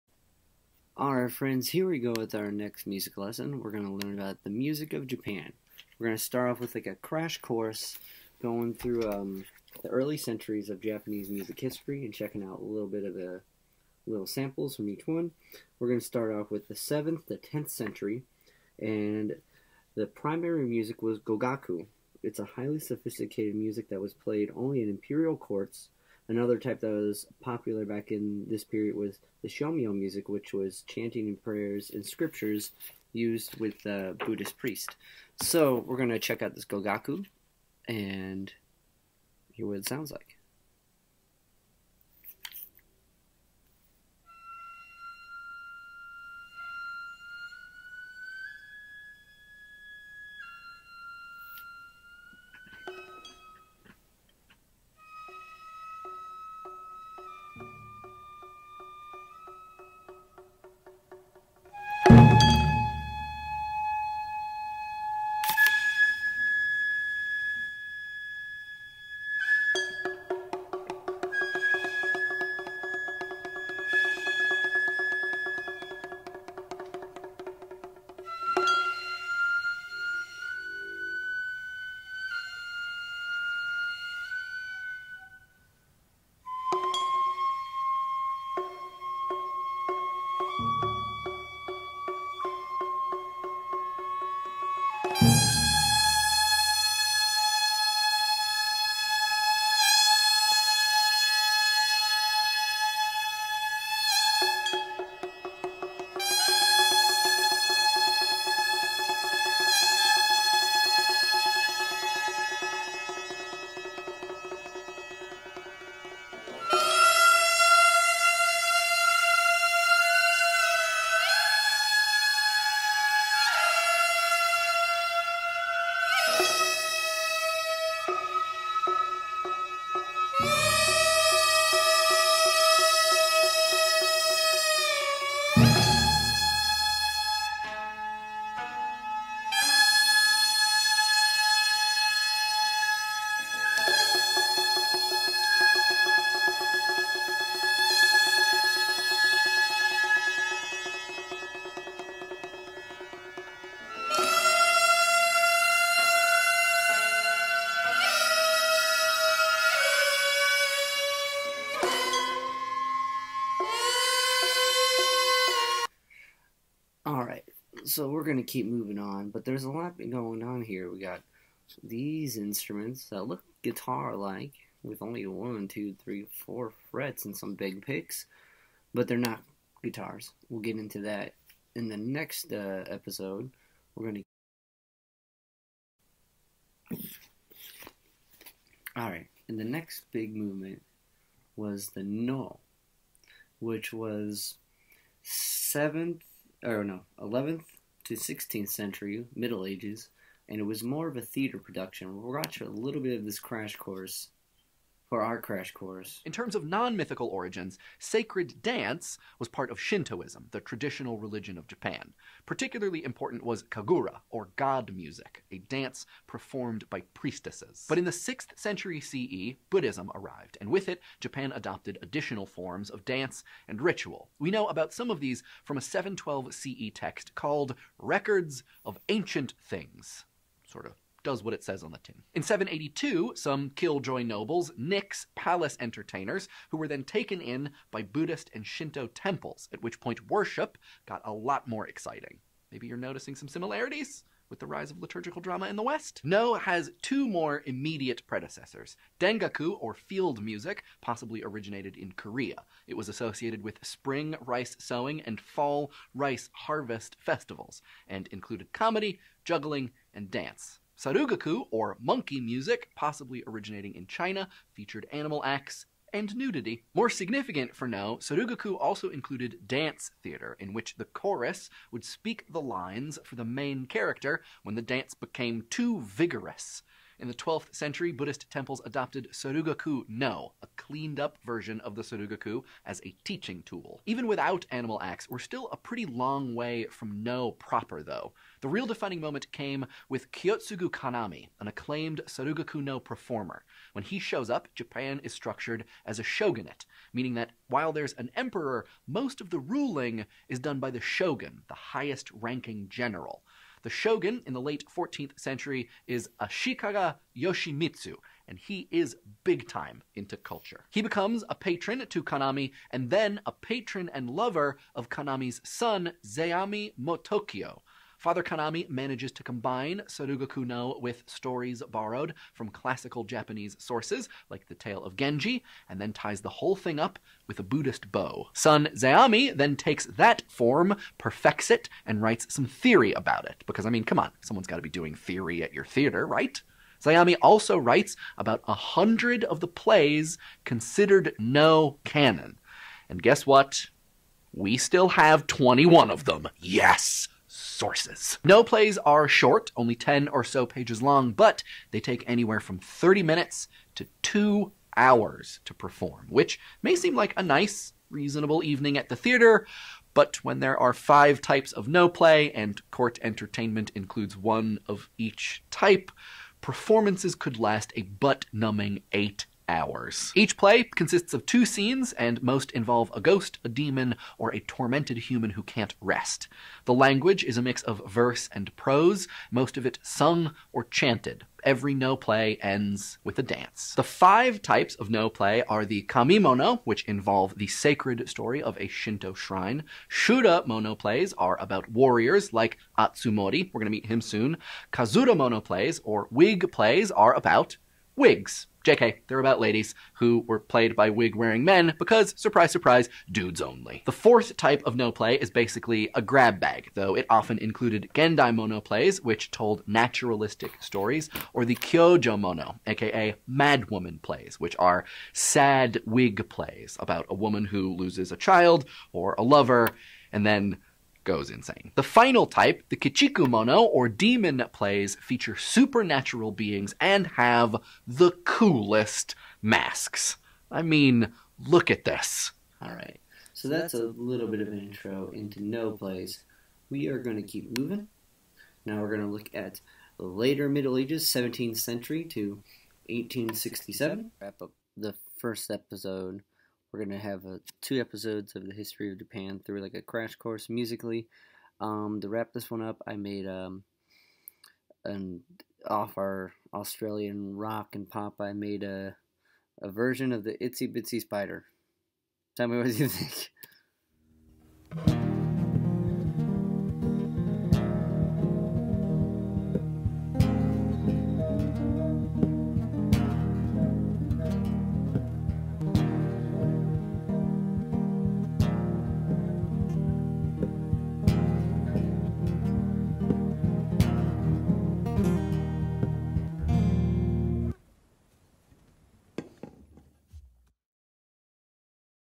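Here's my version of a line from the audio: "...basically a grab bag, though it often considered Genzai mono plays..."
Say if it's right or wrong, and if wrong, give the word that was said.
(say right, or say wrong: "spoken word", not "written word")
wrong: "included", not "considered".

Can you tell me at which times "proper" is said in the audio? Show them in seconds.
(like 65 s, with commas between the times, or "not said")
287 s.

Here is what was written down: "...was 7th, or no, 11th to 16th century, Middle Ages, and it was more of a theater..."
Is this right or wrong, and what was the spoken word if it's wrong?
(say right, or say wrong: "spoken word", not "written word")
right.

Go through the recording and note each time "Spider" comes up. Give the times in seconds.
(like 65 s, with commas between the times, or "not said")
461 s.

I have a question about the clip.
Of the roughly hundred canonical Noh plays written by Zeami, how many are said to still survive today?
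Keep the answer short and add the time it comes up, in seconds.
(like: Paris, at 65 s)
21, at 345 s.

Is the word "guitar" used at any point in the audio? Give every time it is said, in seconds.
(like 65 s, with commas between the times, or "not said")
173 s, 179 s.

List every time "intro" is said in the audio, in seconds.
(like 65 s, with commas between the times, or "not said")
434 s.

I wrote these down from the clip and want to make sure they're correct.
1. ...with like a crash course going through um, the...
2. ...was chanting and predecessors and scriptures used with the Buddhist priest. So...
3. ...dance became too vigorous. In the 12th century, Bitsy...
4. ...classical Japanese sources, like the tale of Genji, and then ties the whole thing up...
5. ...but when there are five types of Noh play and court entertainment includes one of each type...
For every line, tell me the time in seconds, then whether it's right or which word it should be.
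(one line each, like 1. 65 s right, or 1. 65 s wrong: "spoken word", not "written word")
1. 6 s right
2. 30 s wrong: "prayers", not "predecessors"
3. 274 s wrong: "Buddhist", not "Bitsy"
4. 322 s right
5. 360 s right.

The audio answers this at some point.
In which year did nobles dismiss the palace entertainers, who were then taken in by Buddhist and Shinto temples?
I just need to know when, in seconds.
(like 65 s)
232 s.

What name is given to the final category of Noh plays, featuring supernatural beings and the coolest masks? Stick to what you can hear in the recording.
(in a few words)
Kichikumono.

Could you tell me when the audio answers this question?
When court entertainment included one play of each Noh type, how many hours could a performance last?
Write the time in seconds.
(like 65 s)
369 s.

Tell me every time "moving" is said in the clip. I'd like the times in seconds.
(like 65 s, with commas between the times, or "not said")
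168 s, 437 s.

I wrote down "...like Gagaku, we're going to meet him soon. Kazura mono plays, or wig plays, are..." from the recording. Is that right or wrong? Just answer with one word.
wrong.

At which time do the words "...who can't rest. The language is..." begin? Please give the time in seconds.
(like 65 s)
375 s.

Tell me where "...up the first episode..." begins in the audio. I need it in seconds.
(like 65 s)
444 s.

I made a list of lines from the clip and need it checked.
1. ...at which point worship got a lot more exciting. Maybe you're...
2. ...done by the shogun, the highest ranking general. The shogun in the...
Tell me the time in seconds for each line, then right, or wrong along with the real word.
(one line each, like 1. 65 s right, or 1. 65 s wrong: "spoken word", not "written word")
1. 239 s right
2. 300 s right.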